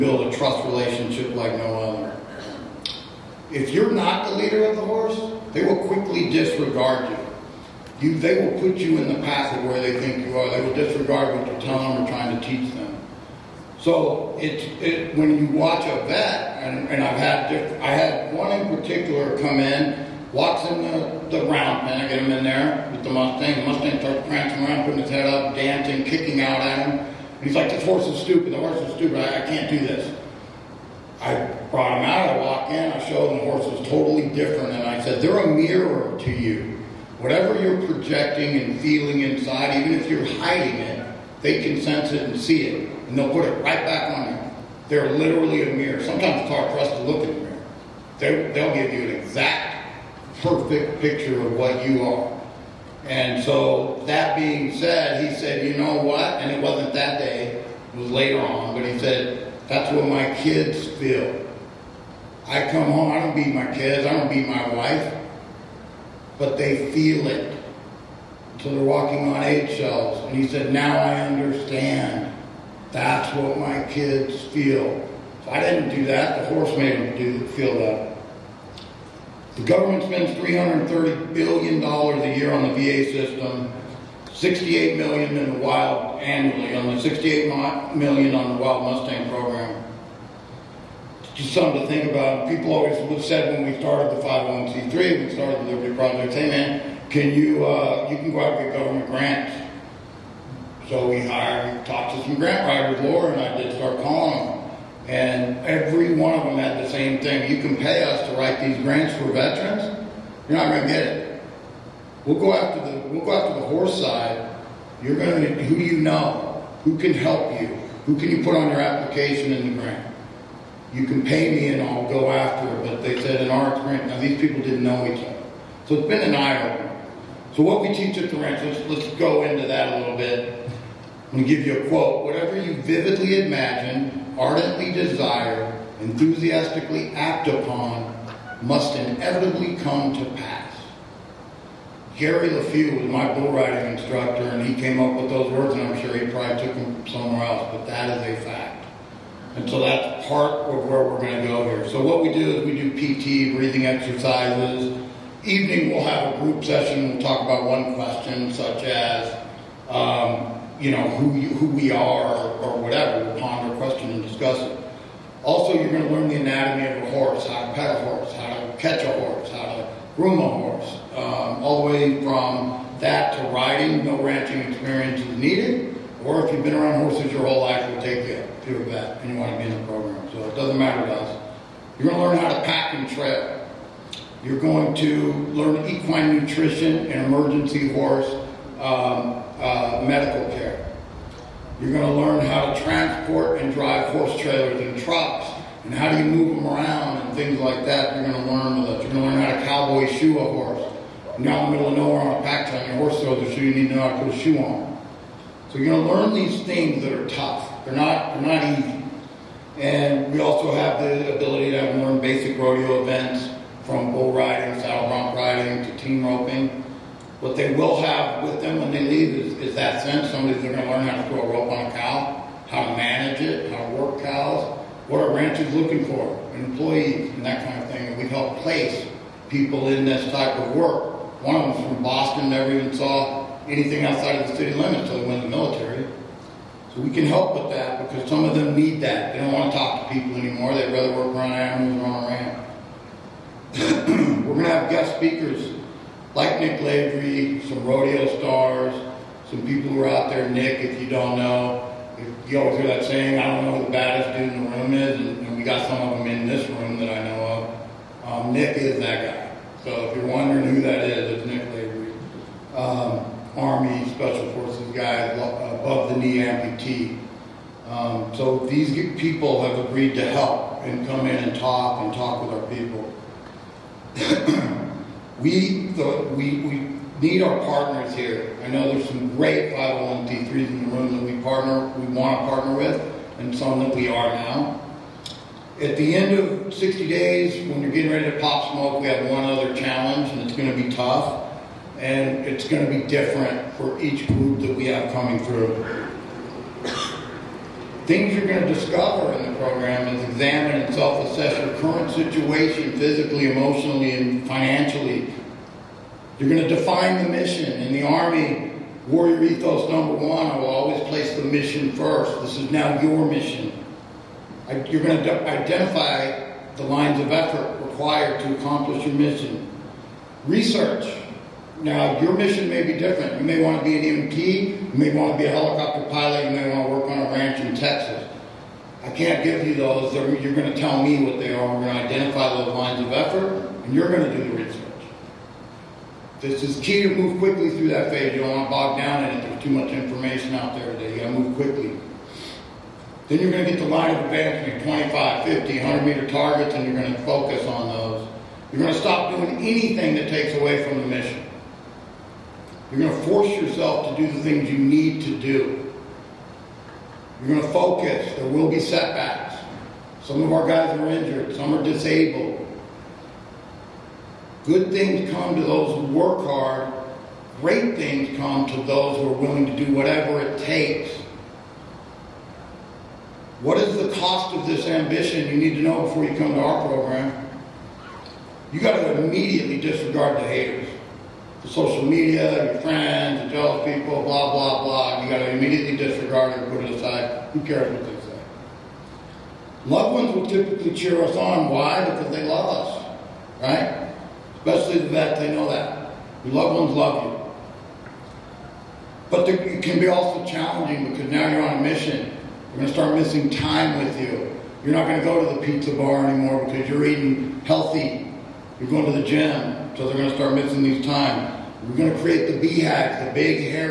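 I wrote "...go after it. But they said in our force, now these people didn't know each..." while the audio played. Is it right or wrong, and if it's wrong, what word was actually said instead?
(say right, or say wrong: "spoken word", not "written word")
wrong: "experience", not "force".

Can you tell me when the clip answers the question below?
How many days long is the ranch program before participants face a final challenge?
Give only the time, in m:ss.
4:46.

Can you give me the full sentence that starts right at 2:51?
Um, all the way from that to riding, no ranching experience is needed.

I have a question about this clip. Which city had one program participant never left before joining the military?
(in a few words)
Boston.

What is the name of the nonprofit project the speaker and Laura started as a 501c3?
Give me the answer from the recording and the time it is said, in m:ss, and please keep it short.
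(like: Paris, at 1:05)
the Liberty Project, at 1:35.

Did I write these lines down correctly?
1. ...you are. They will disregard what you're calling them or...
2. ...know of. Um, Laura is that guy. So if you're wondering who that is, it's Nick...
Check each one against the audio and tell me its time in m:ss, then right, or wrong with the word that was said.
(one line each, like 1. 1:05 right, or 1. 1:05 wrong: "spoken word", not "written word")
1. 0:10 wrong: "telling", not "calling"
2. 4:17 wrong: "Nick", not "Laura".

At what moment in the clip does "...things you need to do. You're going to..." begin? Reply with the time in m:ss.
5:54.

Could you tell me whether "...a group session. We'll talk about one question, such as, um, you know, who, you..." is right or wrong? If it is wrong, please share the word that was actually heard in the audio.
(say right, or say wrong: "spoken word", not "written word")
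right.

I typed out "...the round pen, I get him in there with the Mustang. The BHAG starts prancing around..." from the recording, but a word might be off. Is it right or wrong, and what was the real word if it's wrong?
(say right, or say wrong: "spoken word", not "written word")
wrong: "Mustang", not "BHAG".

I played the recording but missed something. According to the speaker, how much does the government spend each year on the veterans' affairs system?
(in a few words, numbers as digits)
$330 billion.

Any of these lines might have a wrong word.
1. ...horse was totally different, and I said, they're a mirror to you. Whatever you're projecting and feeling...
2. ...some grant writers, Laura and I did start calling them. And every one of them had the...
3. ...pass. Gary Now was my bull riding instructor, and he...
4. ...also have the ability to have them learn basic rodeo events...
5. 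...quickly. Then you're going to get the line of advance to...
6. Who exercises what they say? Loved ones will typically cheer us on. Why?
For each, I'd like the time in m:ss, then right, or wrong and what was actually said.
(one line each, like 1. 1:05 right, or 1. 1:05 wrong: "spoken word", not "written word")
1. 0:33 right
2. 1:42 right
3. 2:20 wrong: "Leffew", not "Now"
4. 3:30 right
5. 5:41 right
6. 6:27 wrong: "cares", not "exercises".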